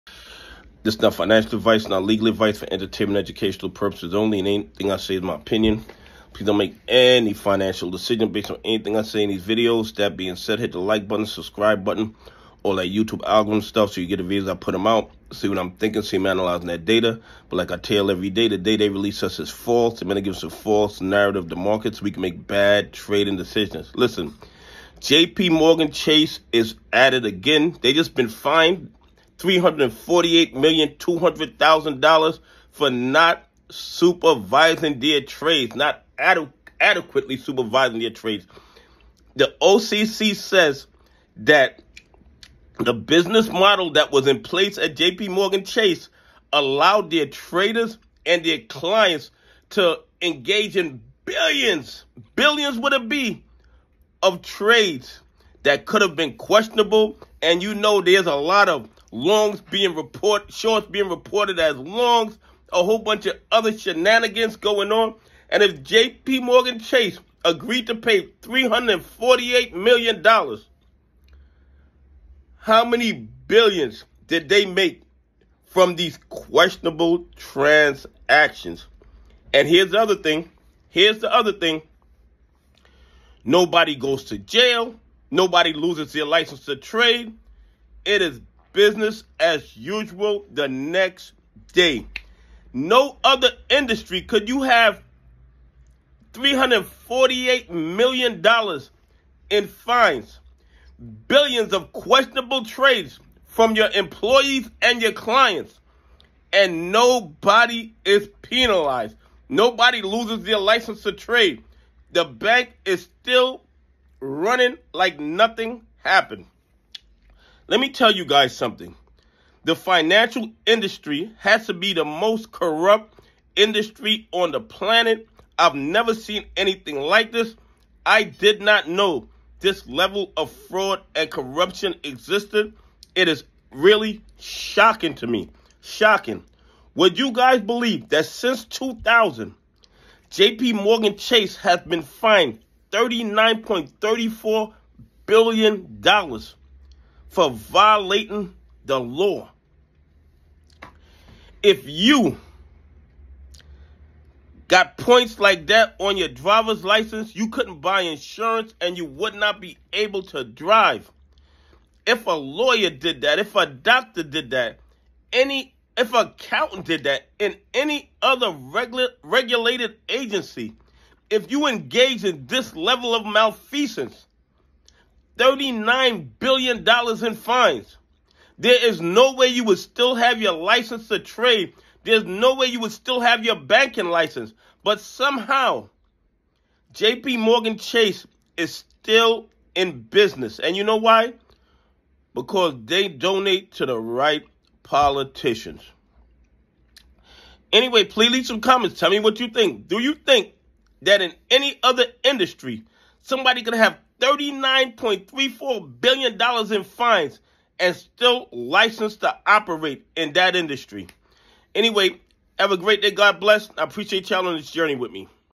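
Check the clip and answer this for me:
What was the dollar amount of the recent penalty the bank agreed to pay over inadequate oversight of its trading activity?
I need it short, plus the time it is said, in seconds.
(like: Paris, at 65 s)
$348,200,000, at 29 s.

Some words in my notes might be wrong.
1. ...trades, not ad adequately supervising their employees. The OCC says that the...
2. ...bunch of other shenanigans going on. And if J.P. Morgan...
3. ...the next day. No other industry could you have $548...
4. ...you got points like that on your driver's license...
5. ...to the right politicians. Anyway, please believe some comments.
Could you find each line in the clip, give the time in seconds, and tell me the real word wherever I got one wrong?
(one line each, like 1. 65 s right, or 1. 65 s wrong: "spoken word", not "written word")
1. 35 s wrong: "trades", not "employees"
2. 62 s right
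3. 90 s wrong: "348", not "548"
4. 151 s right
5. 193 s wrong: "leave", not "believe".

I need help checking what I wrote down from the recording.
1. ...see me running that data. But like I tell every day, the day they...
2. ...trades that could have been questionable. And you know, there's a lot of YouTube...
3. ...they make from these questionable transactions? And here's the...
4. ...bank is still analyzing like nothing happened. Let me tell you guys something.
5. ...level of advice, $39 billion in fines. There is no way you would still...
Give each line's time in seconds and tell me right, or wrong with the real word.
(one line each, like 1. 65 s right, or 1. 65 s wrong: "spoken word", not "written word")
1. 16 s wrong: "analyzing", not "running"
2. 54 s wrong: "Longs", not "YouTube"
3. 74 s right
4. 112 s wrong: "running", not "analyzing"
5. 172 s wrong: "malfeasance", not "advice".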